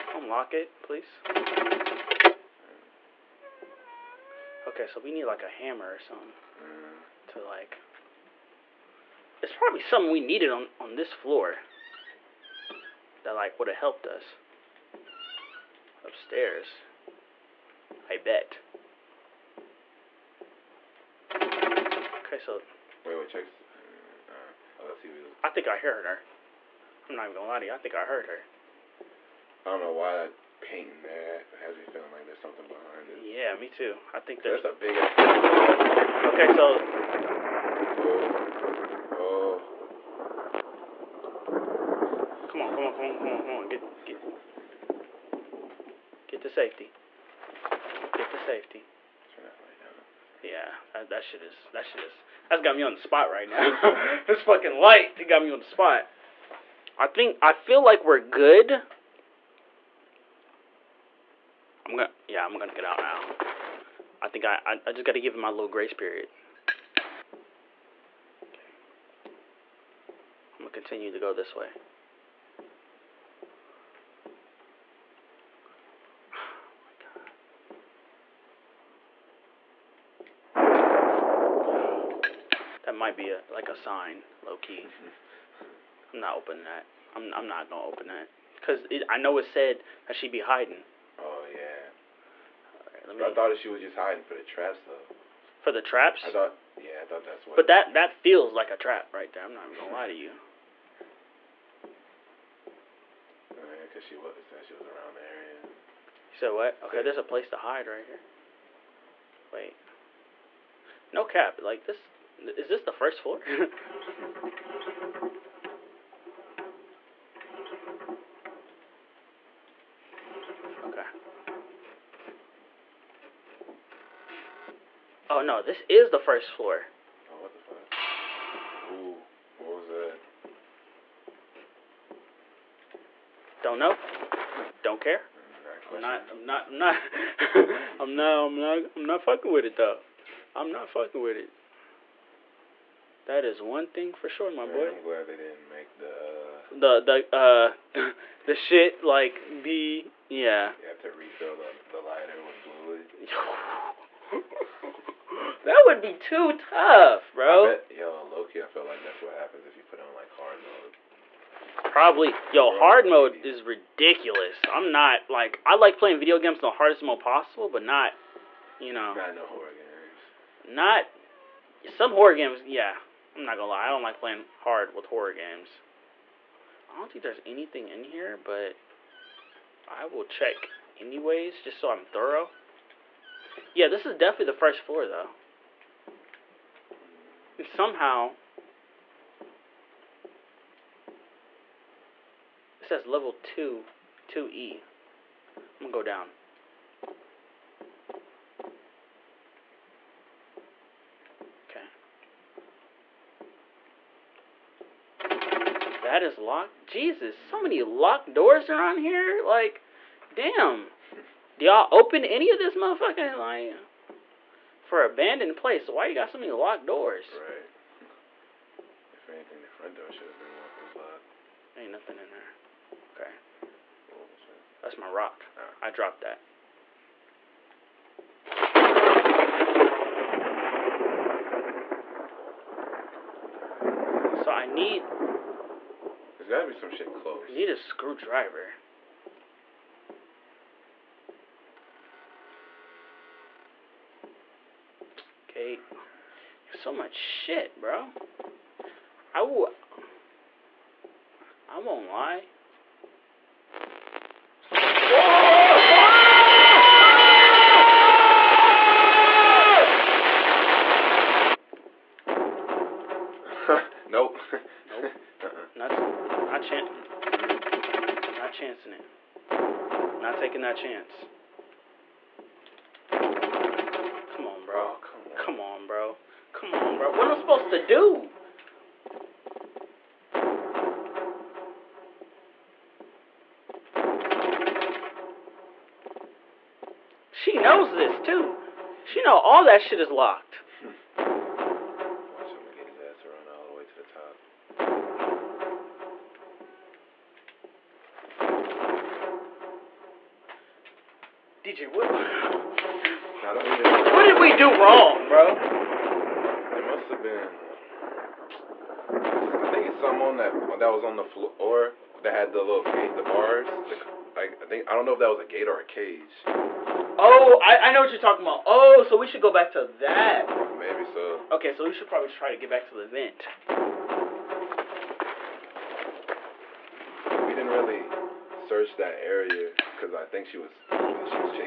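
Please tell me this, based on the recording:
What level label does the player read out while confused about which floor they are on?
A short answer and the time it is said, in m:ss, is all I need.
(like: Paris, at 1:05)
2E, at 3:14.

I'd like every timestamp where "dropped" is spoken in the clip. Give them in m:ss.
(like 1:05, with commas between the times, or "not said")
3:45.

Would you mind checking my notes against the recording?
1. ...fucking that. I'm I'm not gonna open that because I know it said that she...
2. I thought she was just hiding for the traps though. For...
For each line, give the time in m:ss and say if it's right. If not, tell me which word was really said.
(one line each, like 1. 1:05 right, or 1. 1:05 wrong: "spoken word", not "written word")
1. 1:26 wrong: "opening", not "fucking"
2. 1:33 right.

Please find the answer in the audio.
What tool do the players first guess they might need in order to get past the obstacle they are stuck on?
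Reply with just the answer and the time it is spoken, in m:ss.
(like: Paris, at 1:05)
hammer, at 0:05.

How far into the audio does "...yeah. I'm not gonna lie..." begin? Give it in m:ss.
2:52.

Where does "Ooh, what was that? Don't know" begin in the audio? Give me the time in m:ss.
2:08.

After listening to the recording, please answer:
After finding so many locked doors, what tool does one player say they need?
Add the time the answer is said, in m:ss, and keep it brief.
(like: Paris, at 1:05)
screwdriver, at 3:57.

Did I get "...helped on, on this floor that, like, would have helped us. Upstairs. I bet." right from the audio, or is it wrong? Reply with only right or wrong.
wrong.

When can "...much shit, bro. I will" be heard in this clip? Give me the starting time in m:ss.
4:06.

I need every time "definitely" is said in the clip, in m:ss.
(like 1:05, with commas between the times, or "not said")
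3:04.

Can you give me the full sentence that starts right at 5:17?
Oh, I, I know what you're talking about.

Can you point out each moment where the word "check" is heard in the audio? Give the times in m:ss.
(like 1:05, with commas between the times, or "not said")
0:23, 3:00.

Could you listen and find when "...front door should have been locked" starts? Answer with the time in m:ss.
3:39.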